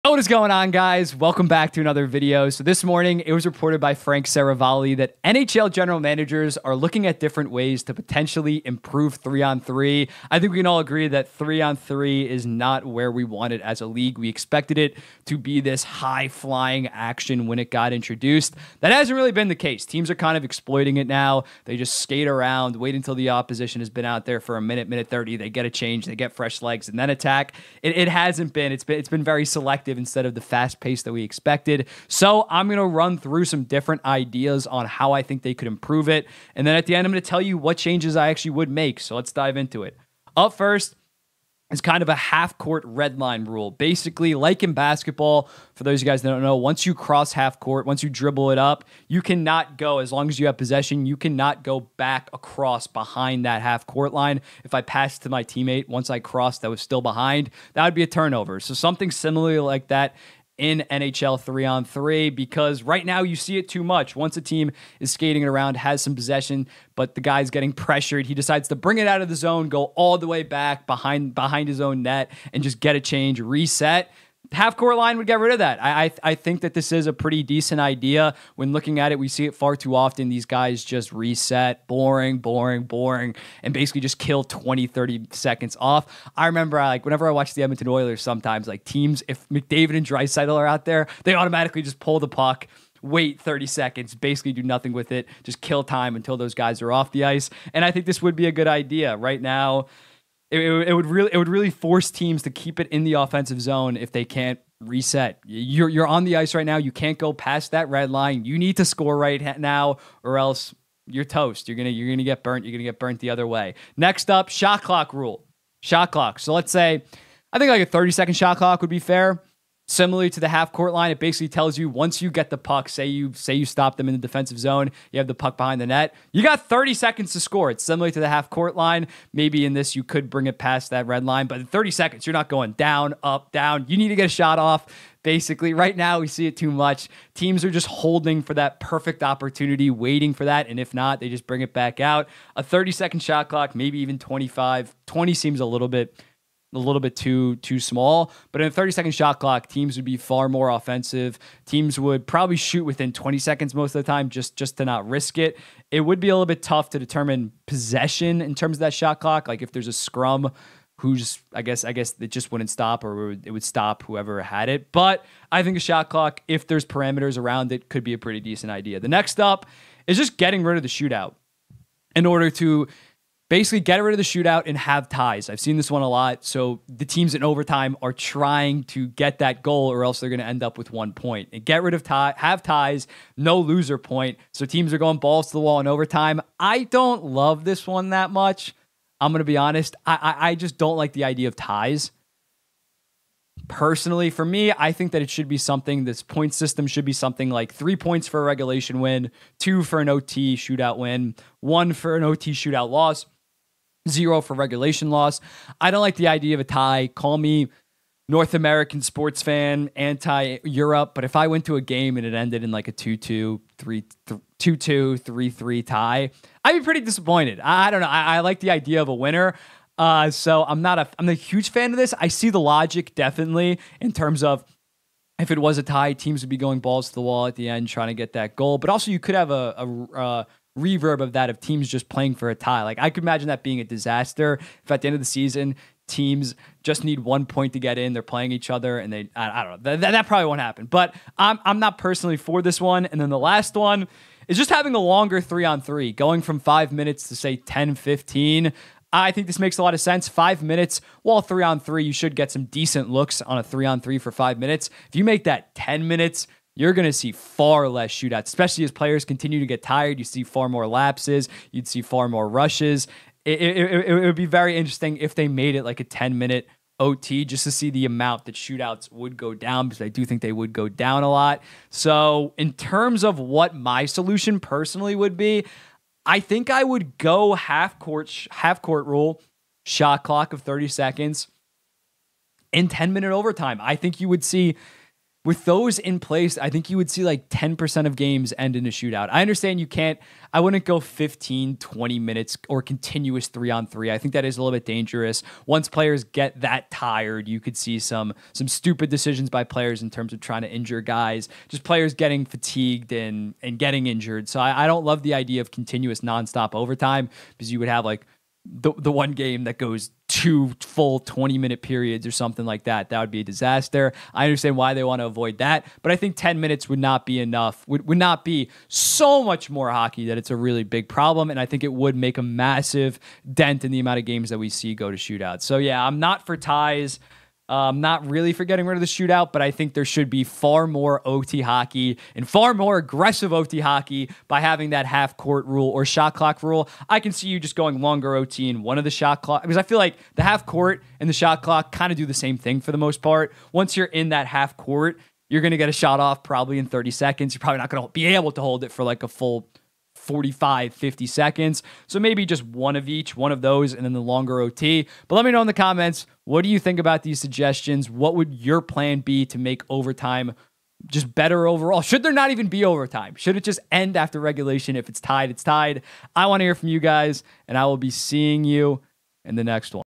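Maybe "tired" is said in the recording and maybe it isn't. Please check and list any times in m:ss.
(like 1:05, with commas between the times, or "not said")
4:19, 4:56.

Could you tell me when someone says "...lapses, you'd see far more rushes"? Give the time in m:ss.
4:20.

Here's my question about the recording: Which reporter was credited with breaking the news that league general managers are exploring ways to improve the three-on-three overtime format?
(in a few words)
Frank Seravalli.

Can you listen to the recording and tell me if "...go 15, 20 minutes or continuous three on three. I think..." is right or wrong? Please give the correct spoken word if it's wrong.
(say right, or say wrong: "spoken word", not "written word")
right.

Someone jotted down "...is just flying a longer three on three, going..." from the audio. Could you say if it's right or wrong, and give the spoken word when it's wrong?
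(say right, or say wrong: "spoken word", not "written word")
wrong: "having", not "flying".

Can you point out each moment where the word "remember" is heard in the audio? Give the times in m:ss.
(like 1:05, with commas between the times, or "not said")
1:26.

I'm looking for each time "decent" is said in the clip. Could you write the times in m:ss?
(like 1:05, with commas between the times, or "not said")
1:17, 2:48, 4:12.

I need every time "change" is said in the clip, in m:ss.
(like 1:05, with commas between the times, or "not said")
0:25, 0:37, 1:12.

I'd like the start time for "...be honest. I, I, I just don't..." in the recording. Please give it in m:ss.
3:09.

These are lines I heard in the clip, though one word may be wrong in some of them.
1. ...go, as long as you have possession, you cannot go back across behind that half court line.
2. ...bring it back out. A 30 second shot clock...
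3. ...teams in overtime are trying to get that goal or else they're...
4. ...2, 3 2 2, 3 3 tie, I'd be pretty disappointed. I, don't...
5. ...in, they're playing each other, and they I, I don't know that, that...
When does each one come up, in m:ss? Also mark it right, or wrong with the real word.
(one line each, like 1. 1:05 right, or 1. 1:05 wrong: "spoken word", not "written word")
1. 0:49 right
2. 2:21 right
3. 2:57 right
4. 3:33 right
5. 3:57 right.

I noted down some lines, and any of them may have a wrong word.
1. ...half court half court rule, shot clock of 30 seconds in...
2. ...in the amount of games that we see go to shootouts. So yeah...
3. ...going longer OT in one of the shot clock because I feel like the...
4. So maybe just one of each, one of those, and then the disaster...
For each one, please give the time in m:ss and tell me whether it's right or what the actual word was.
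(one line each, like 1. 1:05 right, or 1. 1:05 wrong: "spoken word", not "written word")
1. 4:37 right
2. 5:23 right
3. 5:37 right
4. 5:52 wrong: "longer", not "disaster".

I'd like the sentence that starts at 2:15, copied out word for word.
Right now, we see it too much.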